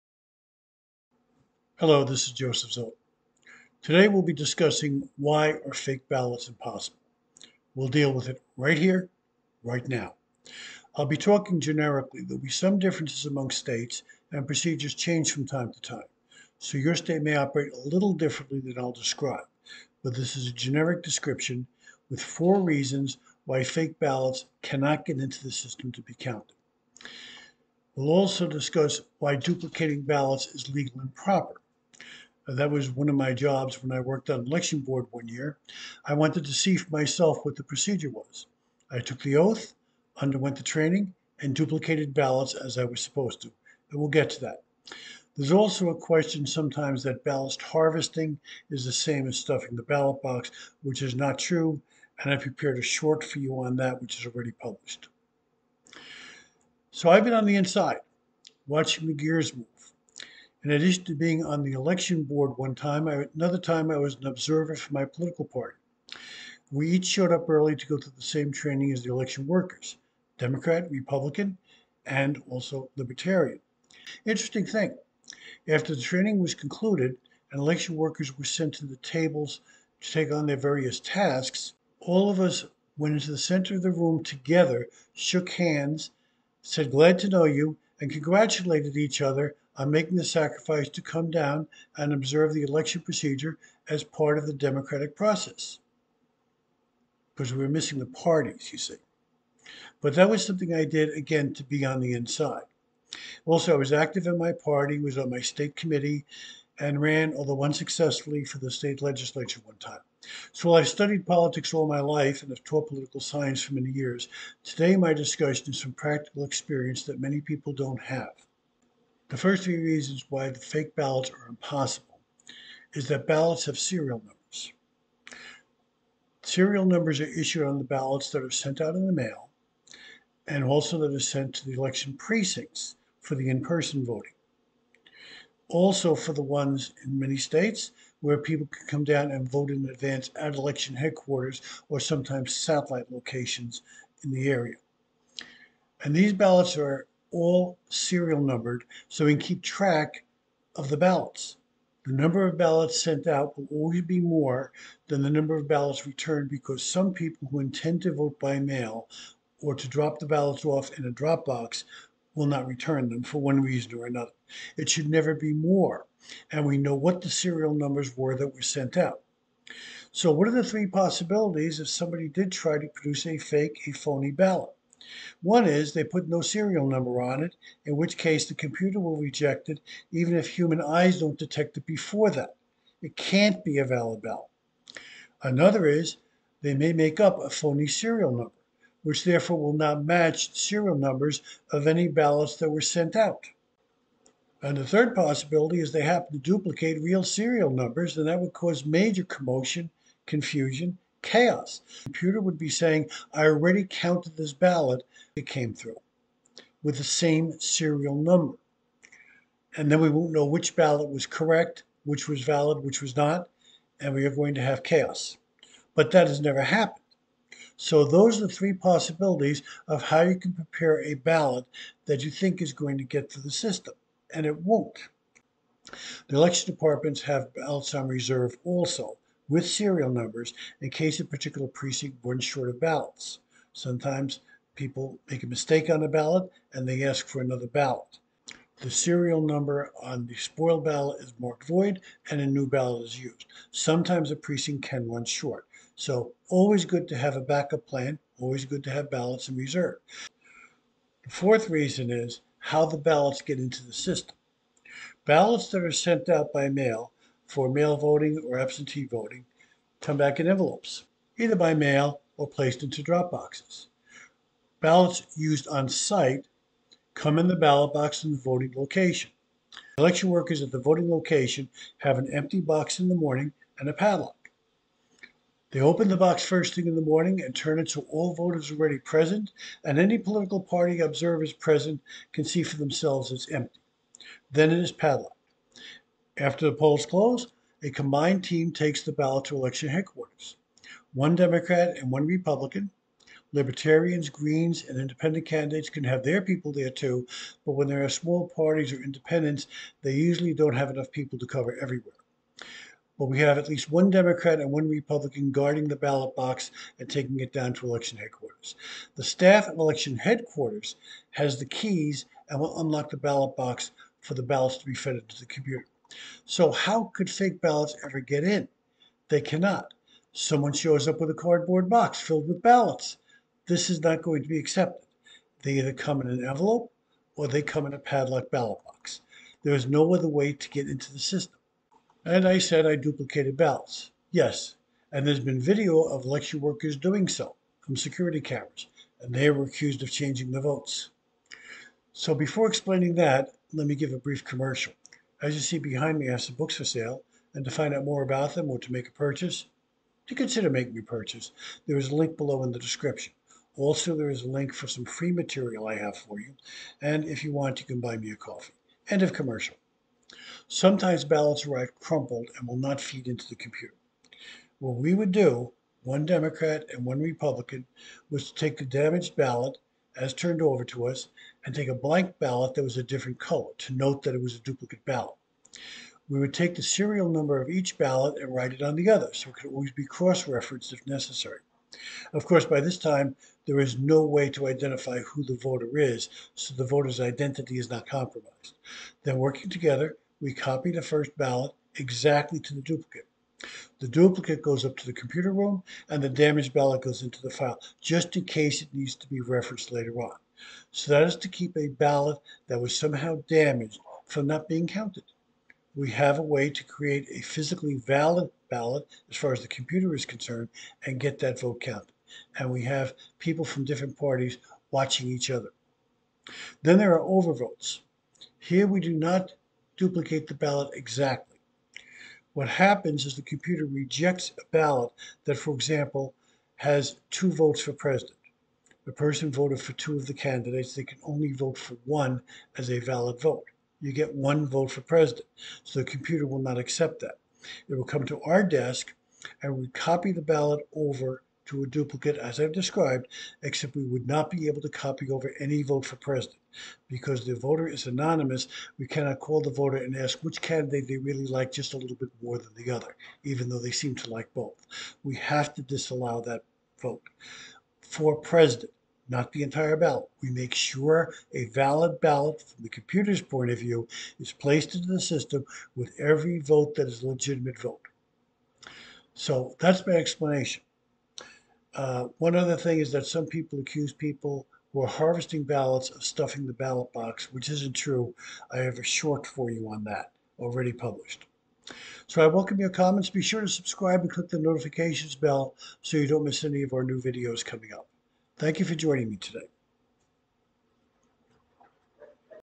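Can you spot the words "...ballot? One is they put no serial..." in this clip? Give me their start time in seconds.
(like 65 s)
174 s.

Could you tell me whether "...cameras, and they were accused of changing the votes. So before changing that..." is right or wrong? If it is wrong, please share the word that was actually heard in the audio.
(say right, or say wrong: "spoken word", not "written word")
wrong: "explaining", not "changing".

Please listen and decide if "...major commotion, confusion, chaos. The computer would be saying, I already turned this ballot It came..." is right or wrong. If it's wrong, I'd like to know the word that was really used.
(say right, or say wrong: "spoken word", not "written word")
wrong: "counted", not "turned".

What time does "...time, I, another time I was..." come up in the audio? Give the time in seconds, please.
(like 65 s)
62 s.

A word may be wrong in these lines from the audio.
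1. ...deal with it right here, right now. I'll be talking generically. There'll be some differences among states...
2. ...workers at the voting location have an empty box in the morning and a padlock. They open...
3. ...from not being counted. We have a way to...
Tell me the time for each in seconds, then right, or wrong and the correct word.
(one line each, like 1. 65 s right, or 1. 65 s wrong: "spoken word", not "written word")
1. 7 s right
2. 270 s right
3. 404 s right.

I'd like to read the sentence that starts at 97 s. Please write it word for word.
Because we were missing the parties, you see.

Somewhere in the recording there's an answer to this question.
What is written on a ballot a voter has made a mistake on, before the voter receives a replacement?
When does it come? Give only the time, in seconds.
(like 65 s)
241 s.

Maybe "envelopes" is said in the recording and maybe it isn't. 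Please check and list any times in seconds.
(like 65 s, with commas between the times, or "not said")
260 s, 326 s.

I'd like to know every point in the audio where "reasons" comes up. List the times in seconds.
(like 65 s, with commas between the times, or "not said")
22 s, 119 s, 163 s, 251 s.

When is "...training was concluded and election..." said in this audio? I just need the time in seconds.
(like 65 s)
76 s.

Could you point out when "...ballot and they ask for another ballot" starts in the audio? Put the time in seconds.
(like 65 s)
236 s.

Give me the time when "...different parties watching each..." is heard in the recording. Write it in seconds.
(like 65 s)
413 s.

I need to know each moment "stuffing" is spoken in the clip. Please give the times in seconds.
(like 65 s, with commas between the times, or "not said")
49 s, 476 s.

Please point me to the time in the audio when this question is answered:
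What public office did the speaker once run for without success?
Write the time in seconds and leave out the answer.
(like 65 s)
108 s.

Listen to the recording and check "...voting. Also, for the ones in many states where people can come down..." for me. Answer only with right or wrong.
right.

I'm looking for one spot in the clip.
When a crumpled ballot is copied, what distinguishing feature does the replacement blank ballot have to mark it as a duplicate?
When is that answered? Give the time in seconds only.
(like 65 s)
372 s.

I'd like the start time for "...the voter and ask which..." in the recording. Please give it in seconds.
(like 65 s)
449 s.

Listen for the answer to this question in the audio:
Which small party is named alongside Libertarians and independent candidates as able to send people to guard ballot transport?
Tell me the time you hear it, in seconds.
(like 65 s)
294 s.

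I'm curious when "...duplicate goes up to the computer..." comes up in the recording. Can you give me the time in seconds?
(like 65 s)
394 s.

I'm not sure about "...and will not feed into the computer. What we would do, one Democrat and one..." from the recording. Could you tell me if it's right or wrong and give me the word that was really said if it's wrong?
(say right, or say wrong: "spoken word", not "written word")
right.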